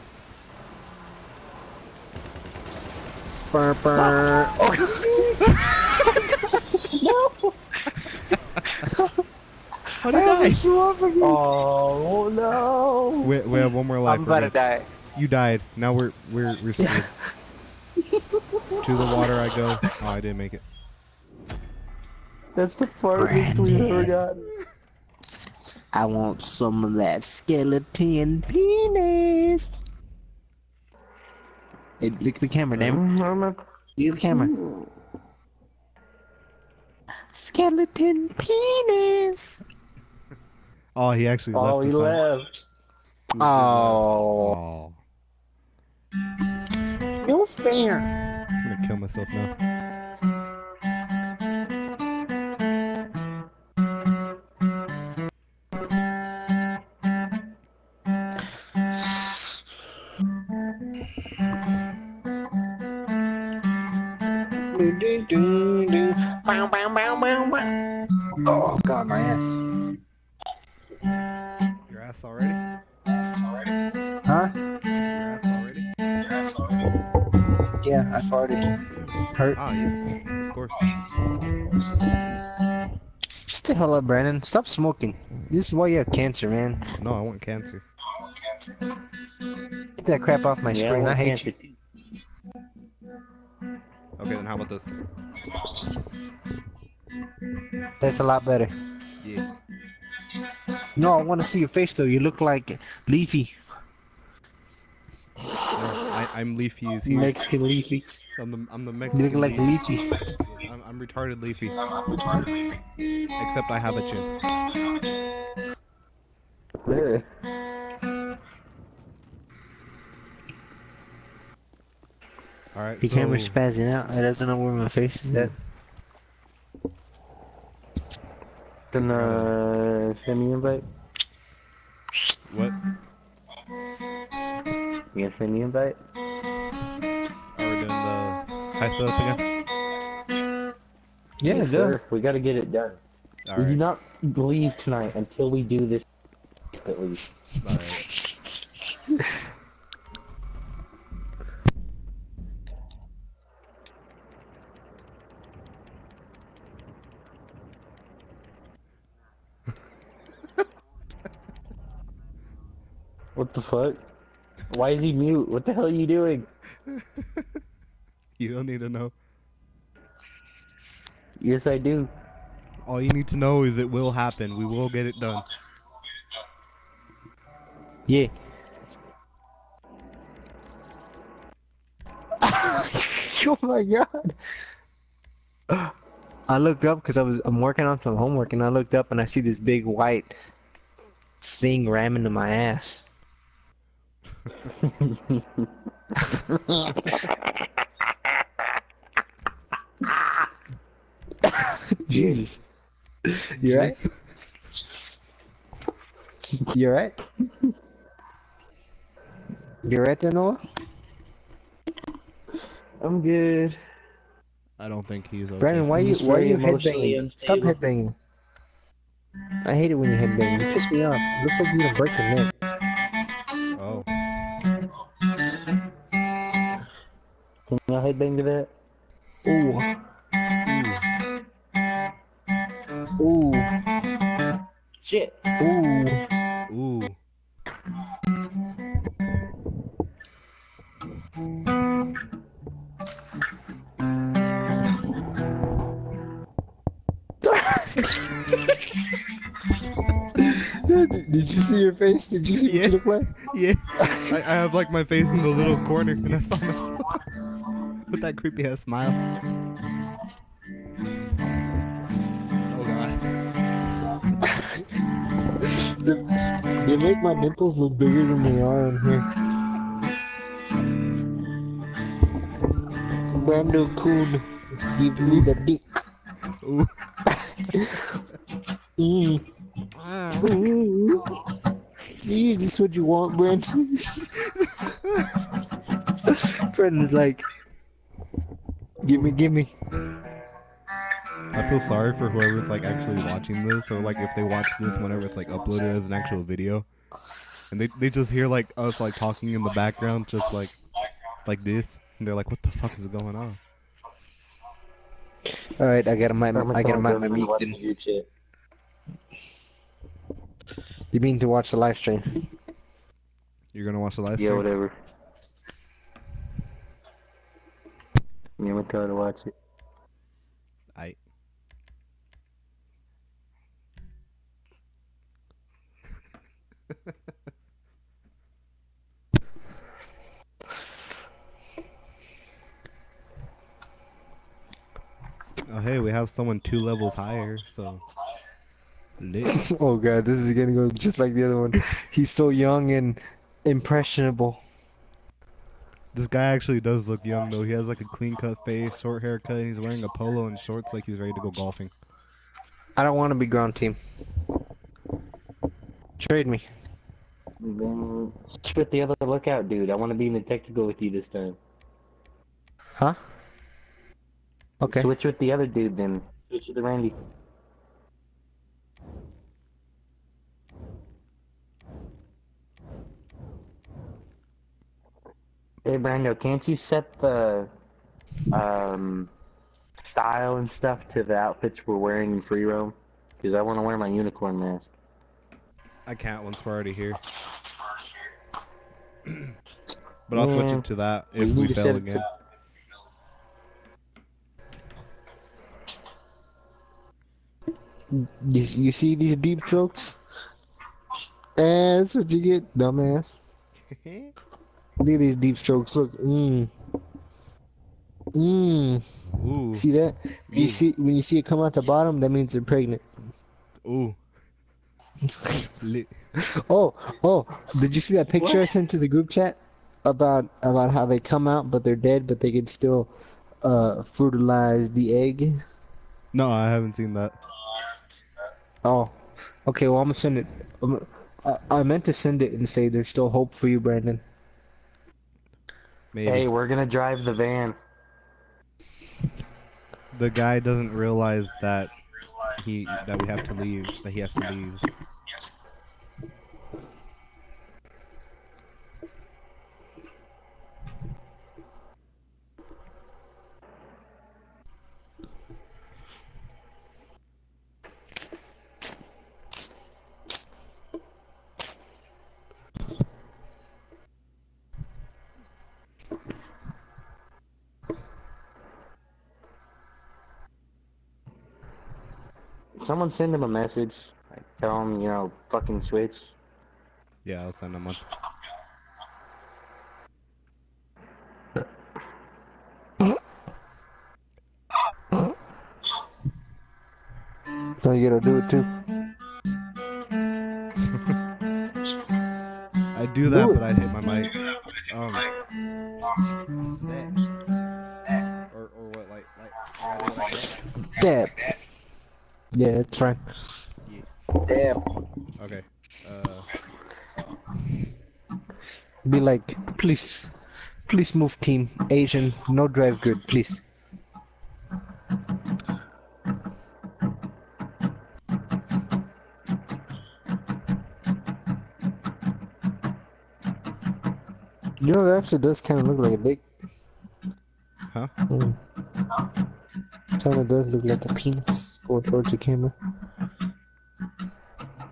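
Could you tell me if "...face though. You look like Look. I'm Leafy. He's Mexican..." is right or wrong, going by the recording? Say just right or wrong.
wrong.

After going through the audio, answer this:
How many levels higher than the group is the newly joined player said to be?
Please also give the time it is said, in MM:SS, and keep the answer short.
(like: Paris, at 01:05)
2, at 05:36.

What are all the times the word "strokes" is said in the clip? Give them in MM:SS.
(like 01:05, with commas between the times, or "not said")
06:39, 06:45.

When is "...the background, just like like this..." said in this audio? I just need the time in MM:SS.
04:59.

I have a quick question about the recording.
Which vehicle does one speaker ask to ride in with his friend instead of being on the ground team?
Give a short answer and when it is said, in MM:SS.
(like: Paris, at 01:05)
The technical, at 06:00.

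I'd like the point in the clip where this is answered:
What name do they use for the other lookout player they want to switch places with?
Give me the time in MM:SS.
06:06.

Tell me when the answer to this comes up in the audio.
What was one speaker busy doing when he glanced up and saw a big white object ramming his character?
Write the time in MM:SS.
03:08.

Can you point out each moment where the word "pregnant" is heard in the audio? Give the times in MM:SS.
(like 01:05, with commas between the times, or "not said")
06:52.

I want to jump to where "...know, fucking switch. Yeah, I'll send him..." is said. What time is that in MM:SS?
07:55.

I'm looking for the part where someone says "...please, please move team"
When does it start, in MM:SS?
08:29.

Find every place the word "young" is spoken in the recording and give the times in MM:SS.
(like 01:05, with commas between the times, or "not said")
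05:42, 05:47.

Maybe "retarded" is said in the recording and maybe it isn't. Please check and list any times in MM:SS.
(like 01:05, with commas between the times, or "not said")
01:50.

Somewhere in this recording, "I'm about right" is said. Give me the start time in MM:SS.
00:14.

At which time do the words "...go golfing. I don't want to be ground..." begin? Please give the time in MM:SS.
05:51.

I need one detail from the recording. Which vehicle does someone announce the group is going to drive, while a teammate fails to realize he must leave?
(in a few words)
The van.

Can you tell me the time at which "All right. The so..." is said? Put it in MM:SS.
02:02.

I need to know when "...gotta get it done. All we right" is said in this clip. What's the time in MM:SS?
02:22.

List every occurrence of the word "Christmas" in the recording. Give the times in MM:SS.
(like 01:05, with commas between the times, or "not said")
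not said.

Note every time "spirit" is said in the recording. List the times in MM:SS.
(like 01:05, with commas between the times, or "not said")
not said.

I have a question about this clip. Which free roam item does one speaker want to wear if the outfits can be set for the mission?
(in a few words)
Unicorn mask.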